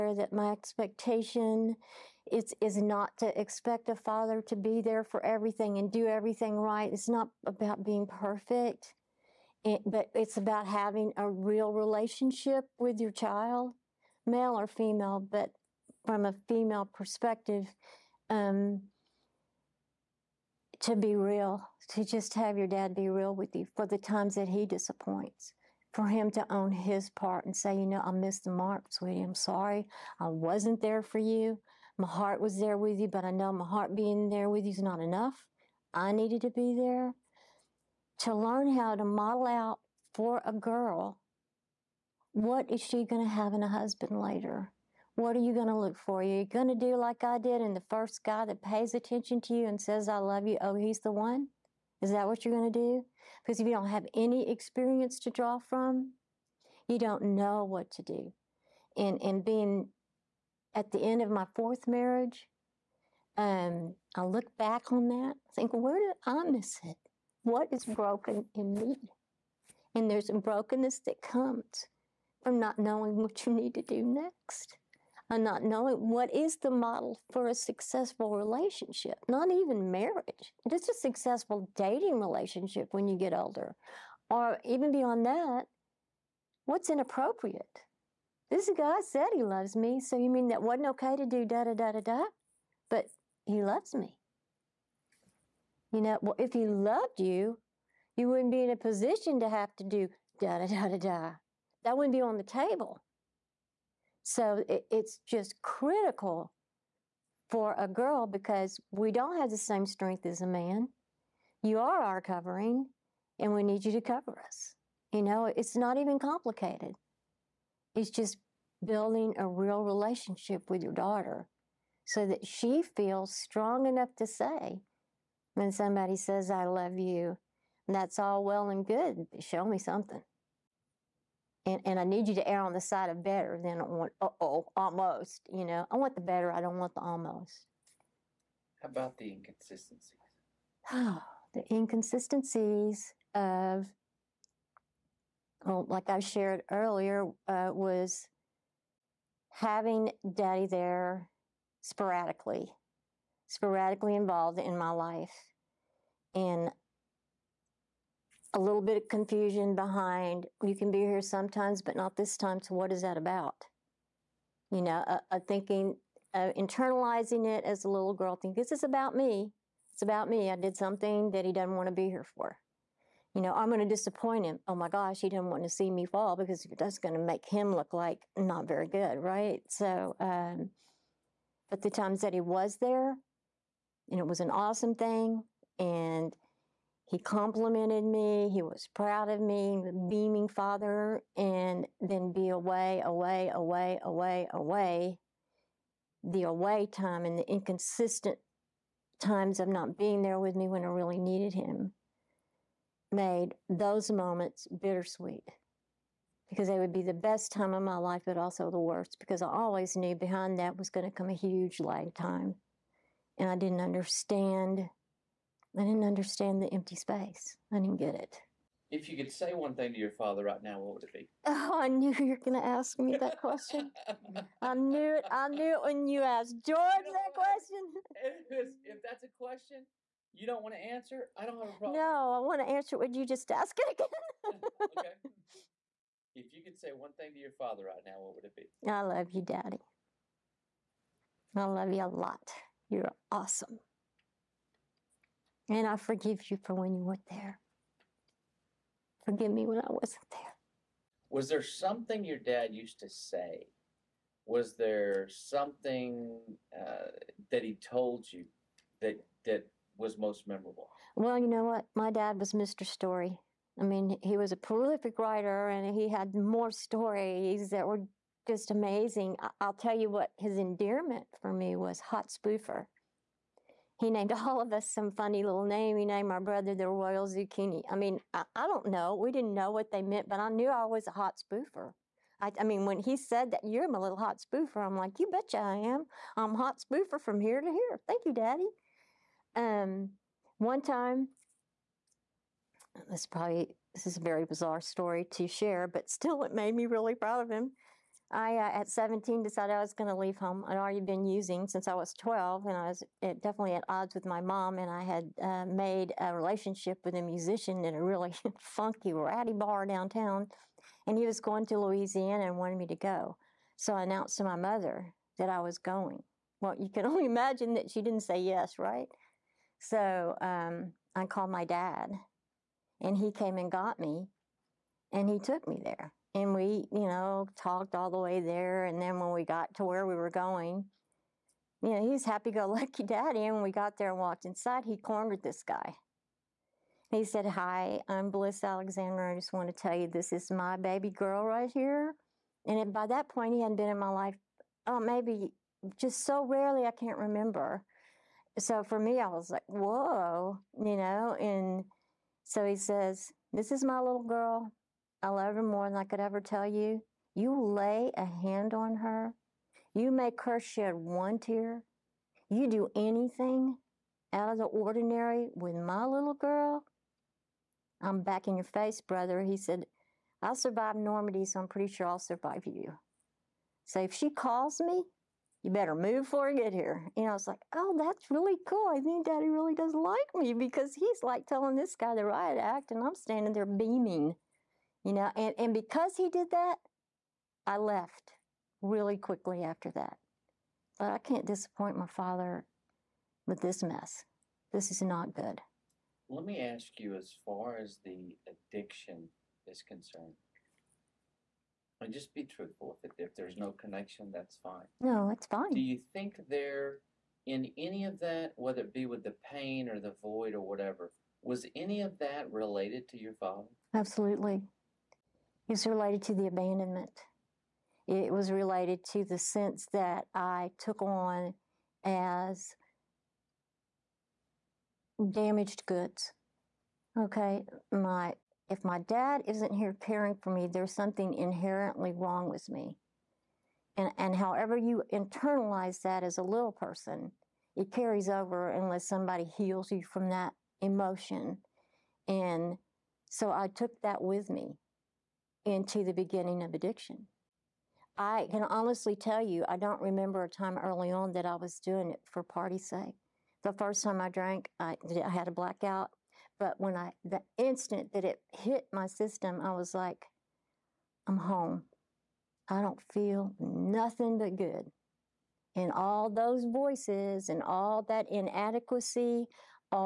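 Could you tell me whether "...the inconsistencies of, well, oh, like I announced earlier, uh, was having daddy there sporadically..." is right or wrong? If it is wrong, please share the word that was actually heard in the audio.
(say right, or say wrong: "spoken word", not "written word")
wrong: "shared", not "announced".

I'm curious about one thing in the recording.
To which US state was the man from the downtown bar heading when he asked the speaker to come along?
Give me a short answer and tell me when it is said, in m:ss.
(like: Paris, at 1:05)
Louisiana, at 5:11.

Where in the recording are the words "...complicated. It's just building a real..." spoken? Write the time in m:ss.
1:56.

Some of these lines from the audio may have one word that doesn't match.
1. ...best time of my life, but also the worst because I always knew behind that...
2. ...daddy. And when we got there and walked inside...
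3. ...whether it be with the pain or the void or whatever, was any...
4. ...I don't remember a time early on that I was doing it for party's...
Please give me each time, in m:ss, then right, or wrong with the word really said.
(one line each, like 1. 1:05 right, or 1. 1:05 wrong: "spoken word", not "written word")
1. 3:27 right
2. 5:33 right
3. 6:48 right
4. 7:29 right.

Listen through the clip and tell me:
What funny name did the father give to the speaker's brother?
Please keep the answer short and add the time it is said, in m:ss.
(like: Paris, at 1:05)
Royal Zucchini, at 4:36.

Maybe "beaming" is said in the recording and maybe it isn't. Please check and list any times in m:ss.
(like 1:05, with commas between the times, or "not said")
3:10, 6:23.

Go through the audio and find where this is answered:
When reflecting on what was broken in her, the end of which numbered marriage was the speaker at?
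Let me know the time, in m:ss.
1:01.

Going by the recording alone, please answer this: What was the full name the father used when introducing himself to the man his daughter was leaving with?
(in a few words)
Bliss Alexander.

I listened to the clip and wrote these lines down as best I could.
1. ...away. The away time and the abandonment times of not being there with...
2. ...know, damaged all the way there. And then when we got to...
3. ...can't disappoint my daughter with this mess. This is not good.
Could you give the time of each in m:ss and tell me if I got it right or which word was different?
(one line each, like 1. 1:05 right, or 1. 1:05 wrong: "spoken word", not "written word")
1. 3:14 wrong: "inconsistent", not "abandonment"
2. 5:27 wrong: "talked", not "damaged"
3. 6:31 wrong: "father", not "daughter".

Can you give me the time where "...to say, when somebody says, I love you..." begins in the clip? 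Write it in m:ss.
2:04.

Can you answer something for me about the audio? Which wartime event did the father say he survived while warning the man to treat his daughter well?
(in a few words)
Normandy.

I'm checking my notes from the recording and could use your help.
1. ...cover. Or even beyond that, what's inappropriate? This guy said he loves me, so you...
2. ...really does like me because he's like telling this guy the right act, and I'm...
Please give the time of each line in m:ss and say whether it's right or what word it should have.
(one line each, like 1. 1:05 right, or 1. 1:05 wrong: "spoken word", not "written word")
1. 1:23 wrong: "older", not "cover"
2. 6:19 right.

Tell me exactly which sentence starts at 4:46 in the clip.
I'm hot spoofer from here to here.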